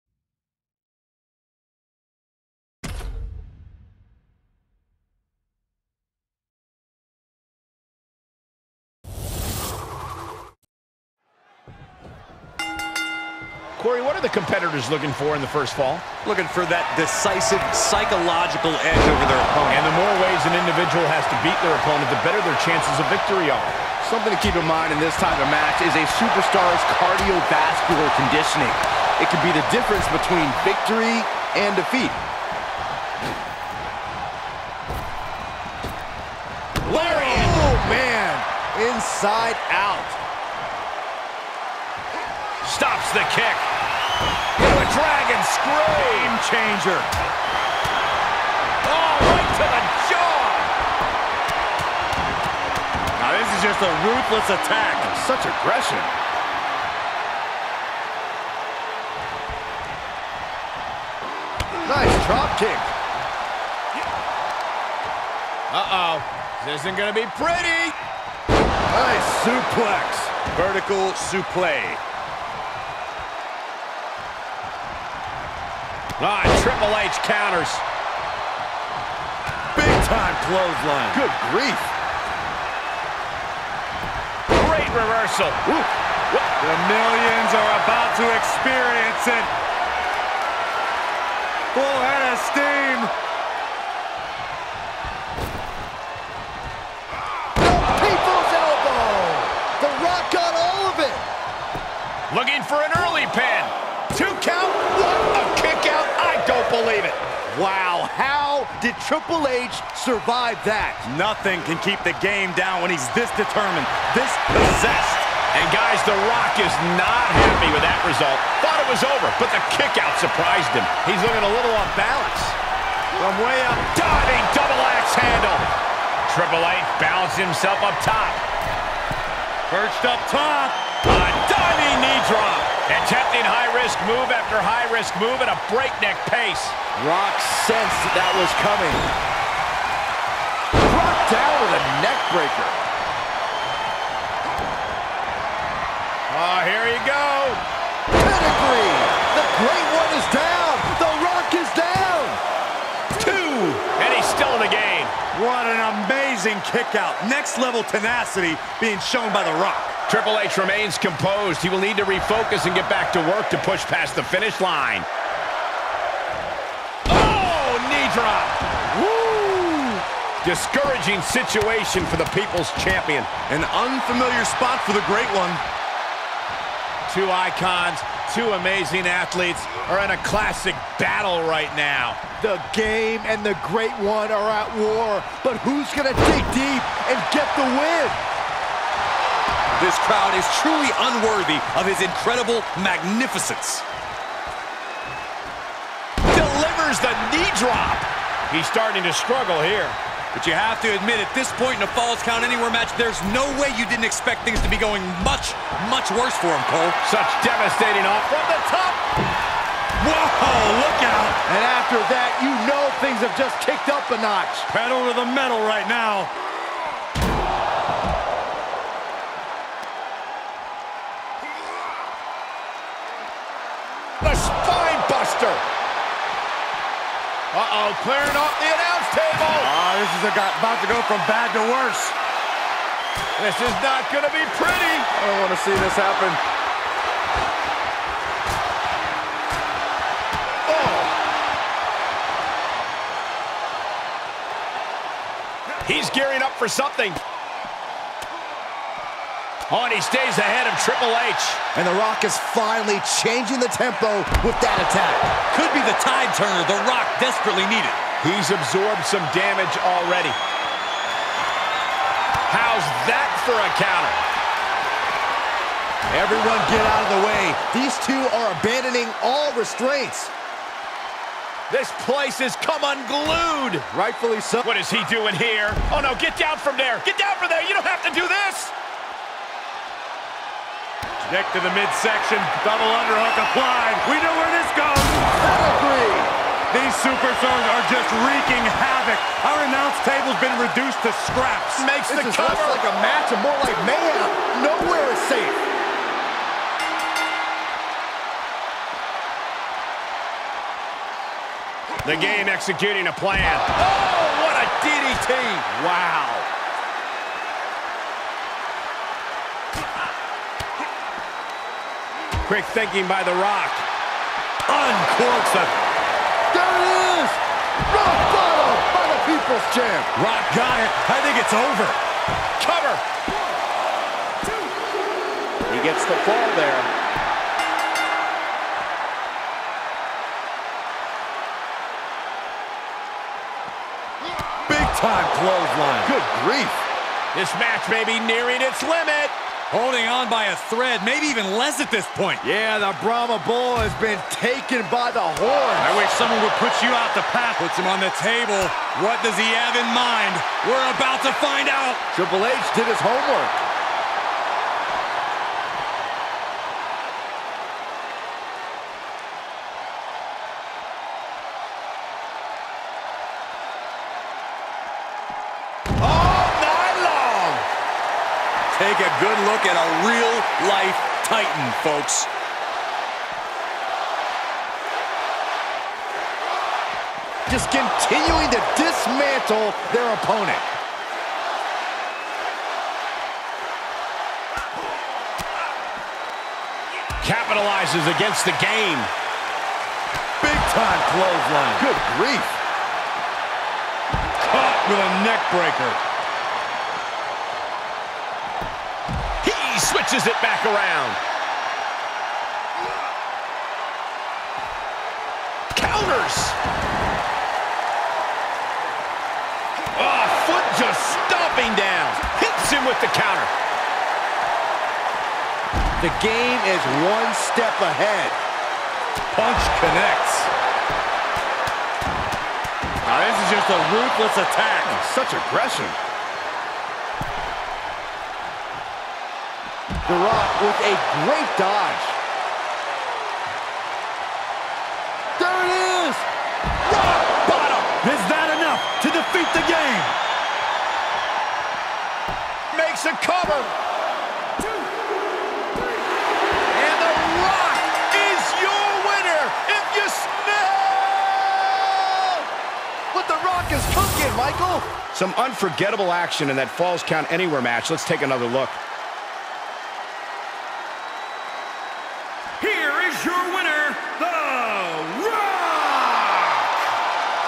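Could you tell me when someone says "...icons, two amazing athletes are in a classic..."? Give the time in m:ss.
2:57.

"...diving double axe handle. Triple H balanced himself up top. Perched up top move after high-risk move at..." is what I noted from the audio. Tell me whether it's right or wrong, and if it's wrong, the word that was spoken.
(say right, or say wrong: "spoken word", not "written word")
right.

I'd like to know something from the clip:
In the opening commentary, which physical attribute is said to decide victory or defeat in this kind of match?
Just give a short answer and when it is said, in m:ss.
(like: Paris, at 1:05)
Cardiovascular conditioning, at 0:27.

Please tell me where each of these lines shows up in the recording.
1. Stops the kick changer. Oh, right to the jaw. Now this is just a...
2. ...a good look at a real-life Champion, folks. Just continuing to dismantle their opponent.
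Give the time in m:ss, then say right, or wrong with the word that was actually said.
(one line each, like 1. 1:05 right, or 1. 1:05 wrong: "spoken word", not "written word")
1. 0:42 right
2. 6:09 wrong: "Titan", not "Champion".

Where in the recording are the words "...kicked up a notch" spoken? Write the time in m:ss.
3:33.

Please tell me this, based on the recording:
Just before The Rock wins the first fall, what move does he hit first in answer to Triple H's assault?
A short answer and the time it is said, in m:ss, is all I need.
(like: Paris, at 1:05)
DDT, at 5:04.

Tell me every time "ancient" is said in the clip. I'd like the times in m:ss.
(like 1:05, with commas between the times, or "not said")
not said.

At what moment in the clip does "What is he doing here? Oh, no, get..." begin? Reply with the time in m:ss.
4:34.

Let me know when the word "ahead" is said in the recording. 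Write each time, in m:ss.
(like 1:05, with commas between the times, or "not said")
4:10, 6:57.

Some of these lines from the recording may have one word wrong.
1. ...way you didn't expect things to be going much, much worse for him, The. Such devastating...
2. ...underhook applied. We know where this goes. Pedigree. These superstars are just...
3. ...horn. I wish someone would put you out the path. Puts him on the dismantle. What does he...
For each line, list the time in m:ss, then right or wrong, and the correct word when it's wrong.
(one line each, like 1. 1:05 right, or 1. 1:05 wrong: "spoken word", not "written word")
1. 3:23 wrong: "Cole", not "The"
2. 4:42 right
3. 5:45 wrong: "table", not "dismantle".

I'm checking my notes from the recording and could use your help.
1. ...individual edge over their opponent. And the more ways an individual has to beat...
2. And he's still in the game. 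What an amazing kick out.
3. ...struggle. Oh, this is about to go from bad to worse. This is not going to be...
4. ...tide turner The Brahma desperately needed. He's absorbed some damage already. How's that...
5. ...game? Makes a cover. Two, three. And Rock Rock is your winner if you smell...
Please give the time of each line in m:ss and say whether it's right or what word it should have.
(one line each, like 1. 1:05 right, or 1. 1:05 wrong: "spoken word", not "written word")
1. 0:17 wrong: "psychological", not "individual"
2. 2:34 right
3. 3:49 wrong: "table", not "struggle"
4. 4:16 wrong: "Rock", not "Brahma"
5. 7:19 wrong: "The", not "Rock".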